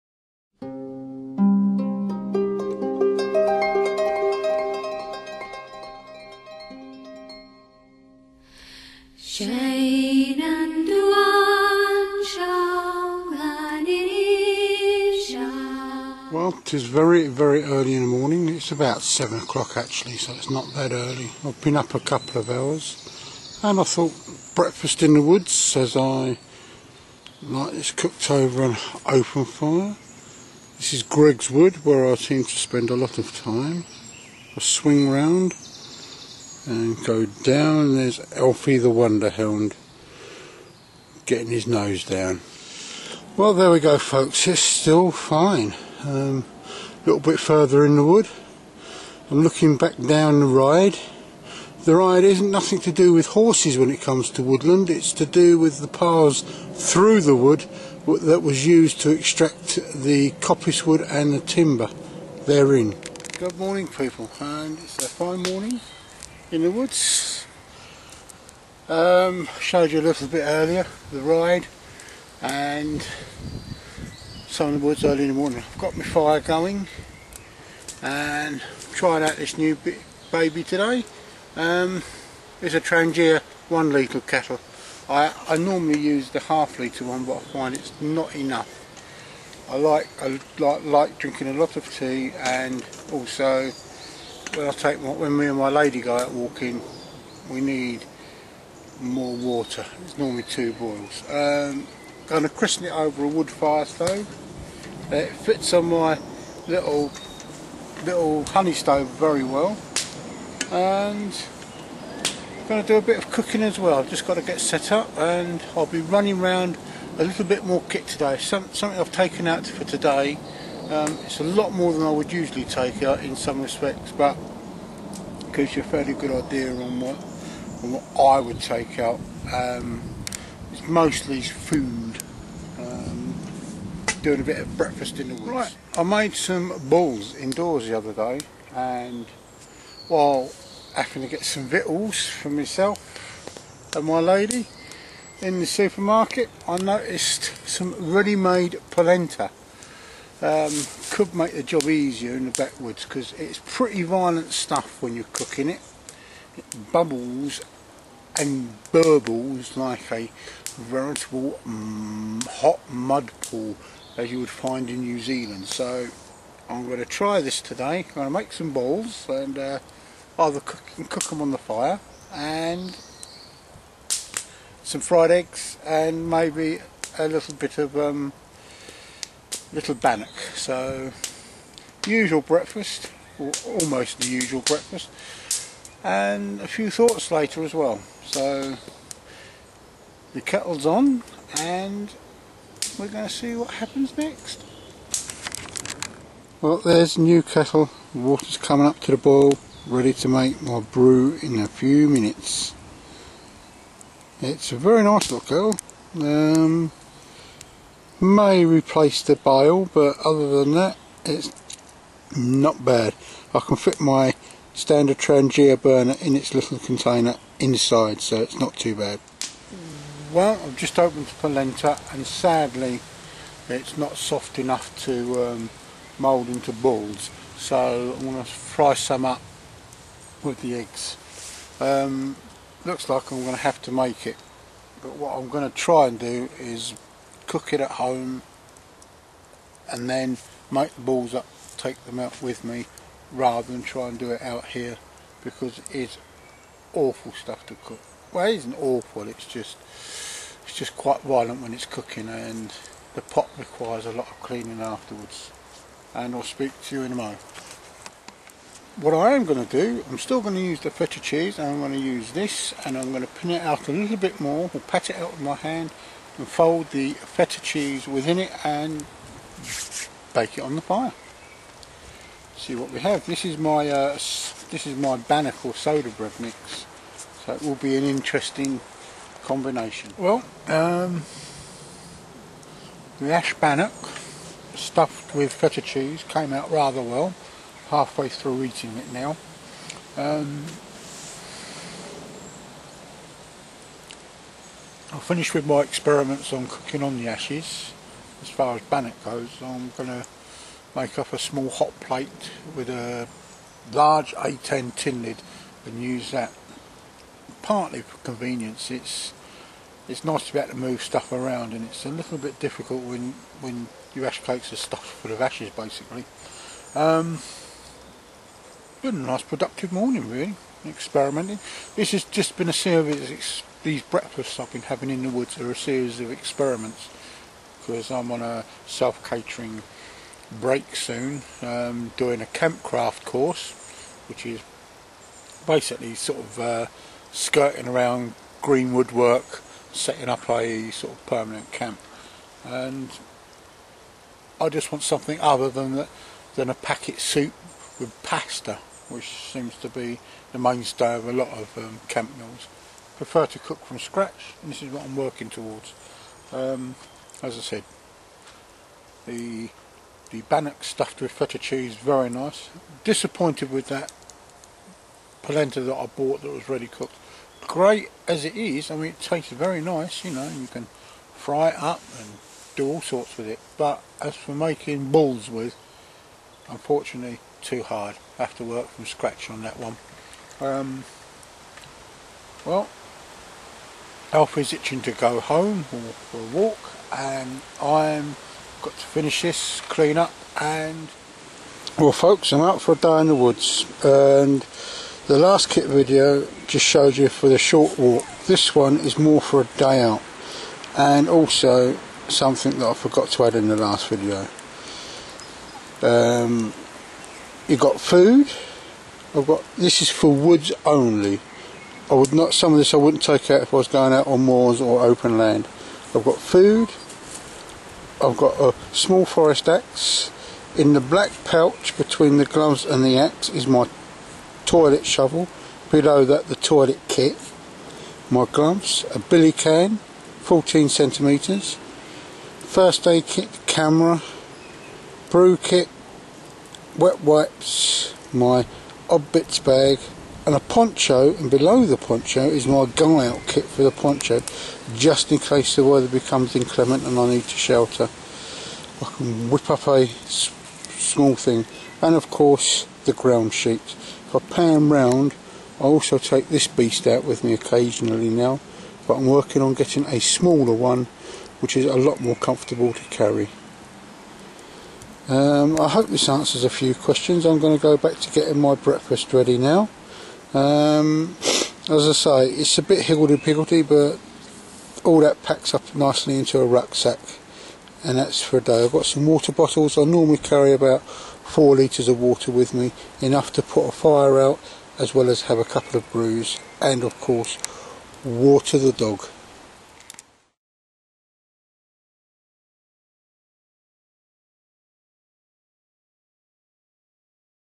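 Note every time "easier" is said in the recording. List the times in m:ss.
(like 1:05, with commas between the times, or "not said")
2:31.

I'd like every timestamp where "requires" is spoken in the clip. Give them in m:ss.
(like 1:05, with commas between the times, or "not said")
4:13.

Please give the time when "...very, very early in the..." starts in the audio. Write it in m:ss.
0:16.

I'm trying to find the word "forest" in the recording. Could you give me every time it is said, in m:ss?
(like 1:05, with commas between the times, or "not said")
6:59.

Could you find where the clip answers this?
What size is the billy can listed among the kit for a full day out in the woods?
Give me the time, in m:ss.
7:10.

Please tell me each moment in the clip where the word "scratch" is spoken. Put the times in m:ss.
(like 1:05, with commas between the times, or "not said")
5:53, 6:19.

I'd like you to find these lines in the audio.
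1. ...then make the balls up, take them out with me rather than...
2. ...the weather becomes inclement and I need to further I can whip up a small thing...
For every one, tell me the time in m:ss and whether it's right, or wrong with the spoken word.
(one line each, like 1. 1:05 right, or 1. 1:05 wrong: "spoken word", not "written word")
1. 4:00 right
2. 7:25 wrong: "shelter", not "further".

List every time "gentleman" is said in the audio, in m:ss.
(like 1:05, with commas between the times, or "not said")
not said.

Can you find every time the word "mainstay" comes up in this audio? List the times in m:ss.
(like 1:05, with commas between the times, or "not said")
5:50.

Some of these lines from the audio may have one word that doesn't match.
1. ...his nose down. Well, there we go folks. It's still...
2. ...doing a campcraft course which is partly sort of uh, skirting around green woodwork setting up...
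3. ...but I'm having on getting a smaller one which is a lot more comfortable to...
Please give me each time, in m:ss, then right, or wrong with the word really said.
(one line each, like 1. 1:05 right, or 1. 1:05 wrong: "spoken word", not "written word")
1. 0:41 right
2. 5:32 wrong: "basically", not "partly"
3. 7:39 wrong: "working", not "having".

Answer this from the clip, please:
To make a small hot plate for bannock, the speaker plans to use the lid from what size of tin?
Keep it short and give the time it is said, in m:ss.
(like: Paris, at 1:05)
A10, at 5:04.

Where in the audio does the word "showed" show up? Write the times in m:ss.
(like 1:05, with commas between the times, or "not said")
1:09, 6:36.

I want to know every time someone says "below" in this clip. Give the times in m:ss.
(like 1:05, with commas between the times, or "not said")
7:05, 7:21.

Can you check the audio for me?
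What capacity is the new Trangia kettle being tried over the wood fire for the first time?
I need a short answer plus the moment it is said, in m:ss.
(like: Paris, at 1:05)
1 litre, at 1:23.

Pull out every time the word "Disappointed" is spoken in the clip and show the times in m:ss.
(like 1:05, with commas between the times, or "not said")
6:03.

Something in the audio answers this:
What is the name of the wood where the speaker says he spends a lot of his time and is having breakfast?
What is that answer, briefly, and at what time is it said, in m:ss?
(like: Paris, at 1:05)
Greg's Wood, at 0:31.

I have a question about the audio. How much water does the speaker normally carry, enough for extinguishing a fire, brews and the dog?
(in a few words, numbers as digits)
4 litres.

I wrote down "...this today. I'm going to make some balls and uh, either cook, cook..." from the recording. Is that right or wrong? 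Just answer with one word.
right.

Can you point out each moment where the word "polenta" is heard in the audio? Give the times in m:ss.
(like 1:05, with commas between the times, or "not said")
2:28, 3:41, 6:05.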